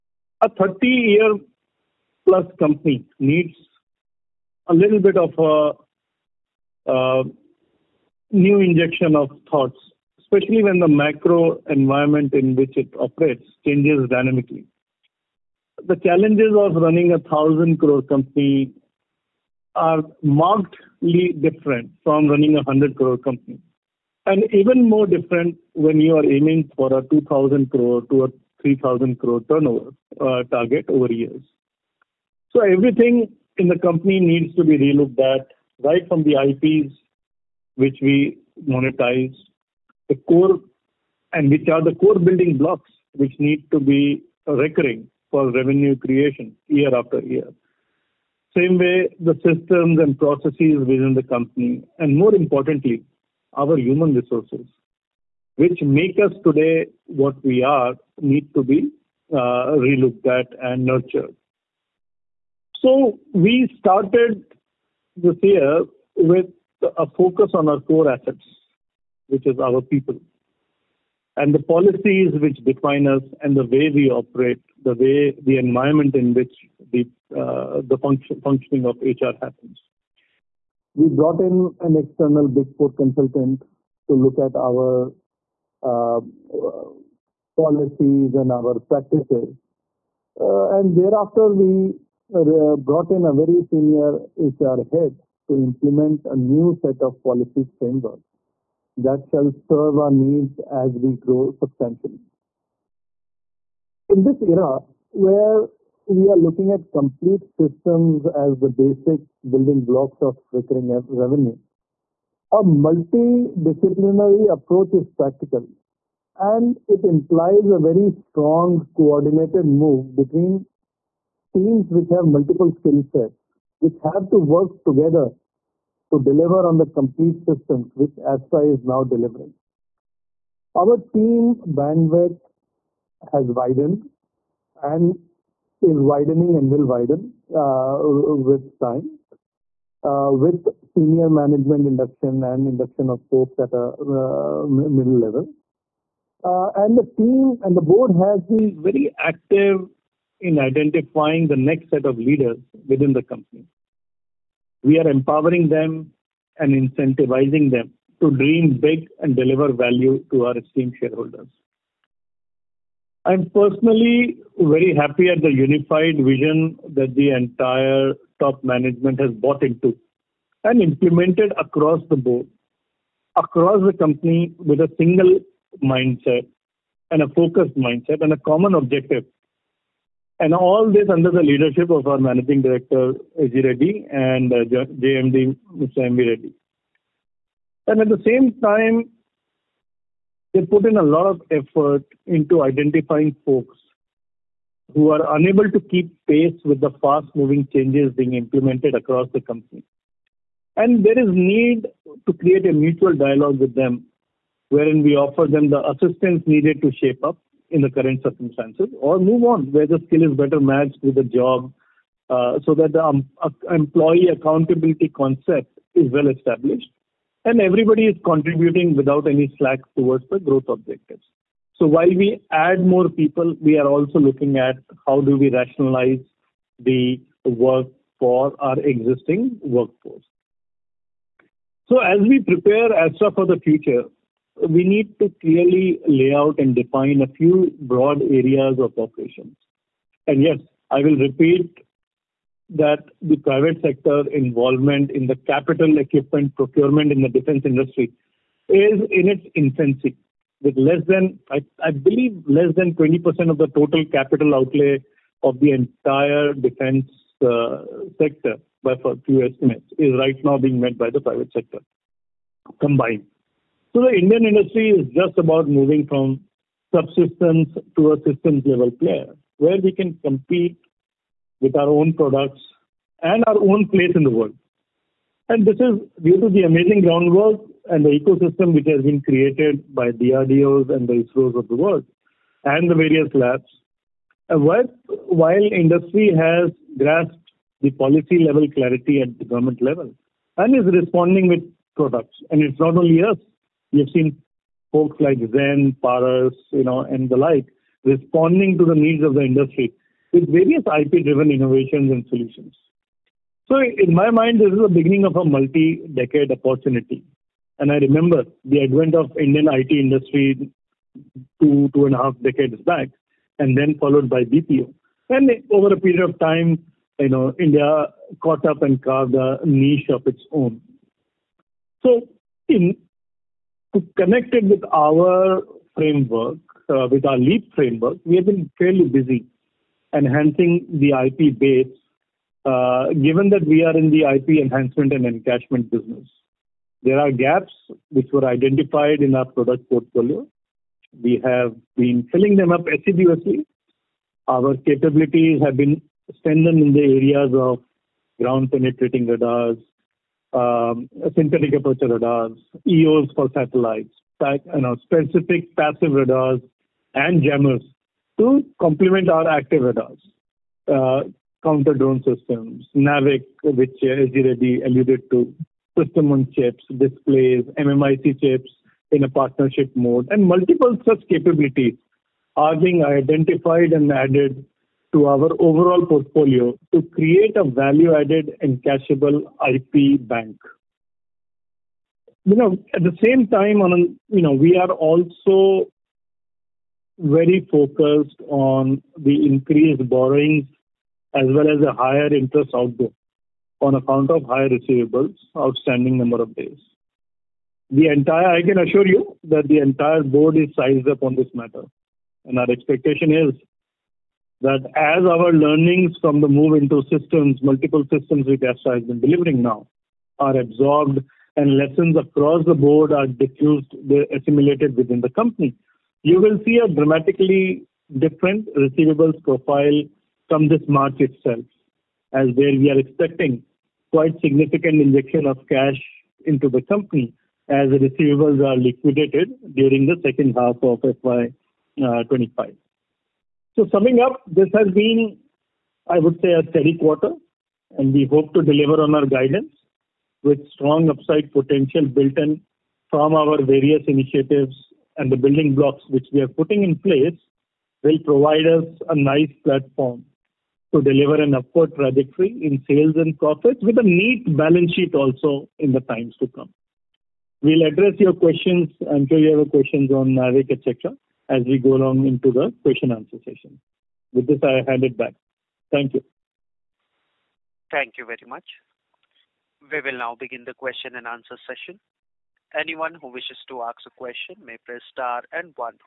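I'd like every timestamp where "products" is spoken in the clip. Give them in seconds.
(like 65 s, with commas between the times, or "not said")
272 s, 291 s, 339 s.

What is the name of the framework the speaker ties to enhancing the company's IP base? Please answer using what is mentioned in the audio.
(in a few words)
LEAP.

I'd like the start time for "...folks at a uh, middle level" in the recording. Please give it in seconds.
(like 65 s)
143 s.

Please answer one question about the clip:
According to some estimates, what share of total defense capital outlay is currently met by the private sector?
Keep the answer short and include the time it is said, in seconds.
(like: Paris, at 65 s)
less than 20%, at 252 s.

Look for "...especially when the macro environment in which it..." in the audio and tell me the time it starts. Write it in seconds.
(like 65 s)
10 s.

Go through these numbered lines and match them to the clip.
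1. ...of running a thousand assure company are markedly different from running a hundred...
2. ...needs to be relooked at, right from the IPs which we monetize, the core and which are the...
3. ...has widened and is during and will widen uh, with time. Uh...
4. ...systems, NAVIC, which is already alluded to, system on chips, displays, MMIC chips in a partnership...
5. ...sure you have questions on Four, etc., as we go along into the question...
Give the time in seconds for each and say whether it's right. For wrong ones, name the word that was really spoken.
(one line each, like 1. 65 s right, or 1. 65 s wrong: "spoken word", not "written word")
1. 16 s wrong: "crore", not "assure"
2. 34 s right
3. 133 s wrong: "widening", not "during"
4. 362 s right
5. 459 s wrong: "NAVIC", not "Four".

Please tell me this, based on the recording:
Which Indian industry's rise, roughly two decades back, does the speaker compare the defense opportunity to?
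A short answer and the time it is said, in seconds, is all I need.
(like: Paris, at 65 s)
IT industry, at 309 s.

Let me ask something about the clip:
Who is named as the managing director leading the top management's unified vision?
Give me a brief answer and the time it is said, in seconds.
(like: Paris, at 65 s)
Ajay Reddy, at 183 s.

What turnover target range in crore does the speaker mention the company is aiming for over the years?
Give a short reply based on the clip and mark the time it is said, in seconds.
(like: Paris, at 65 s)
2,000 to 3,000 crore, at 27 s.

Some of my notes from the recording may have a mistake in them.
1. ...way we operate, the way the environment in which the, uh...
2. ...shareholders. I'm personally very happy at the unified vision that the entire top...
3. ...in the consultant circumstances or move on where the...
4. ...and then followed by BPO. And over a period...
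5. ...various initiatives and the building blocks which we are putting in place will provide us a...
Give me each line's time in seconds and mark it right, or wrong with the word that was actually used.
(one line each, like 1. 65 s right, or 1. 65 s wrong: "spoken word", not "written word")
1. 73 s right
2. 160 s right
3. 207 s wrong: "current", not "consultant"
4. 313 s right
5. 443 s right.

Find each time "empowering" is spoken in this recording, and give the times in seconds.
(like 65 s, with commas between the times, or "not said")
155 s.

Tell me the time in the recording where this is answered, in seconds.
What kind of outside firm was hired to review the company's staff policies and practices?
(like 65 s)
82 s.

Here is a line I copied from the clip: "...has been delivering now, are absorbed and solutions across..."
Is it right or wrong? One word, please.
wrong.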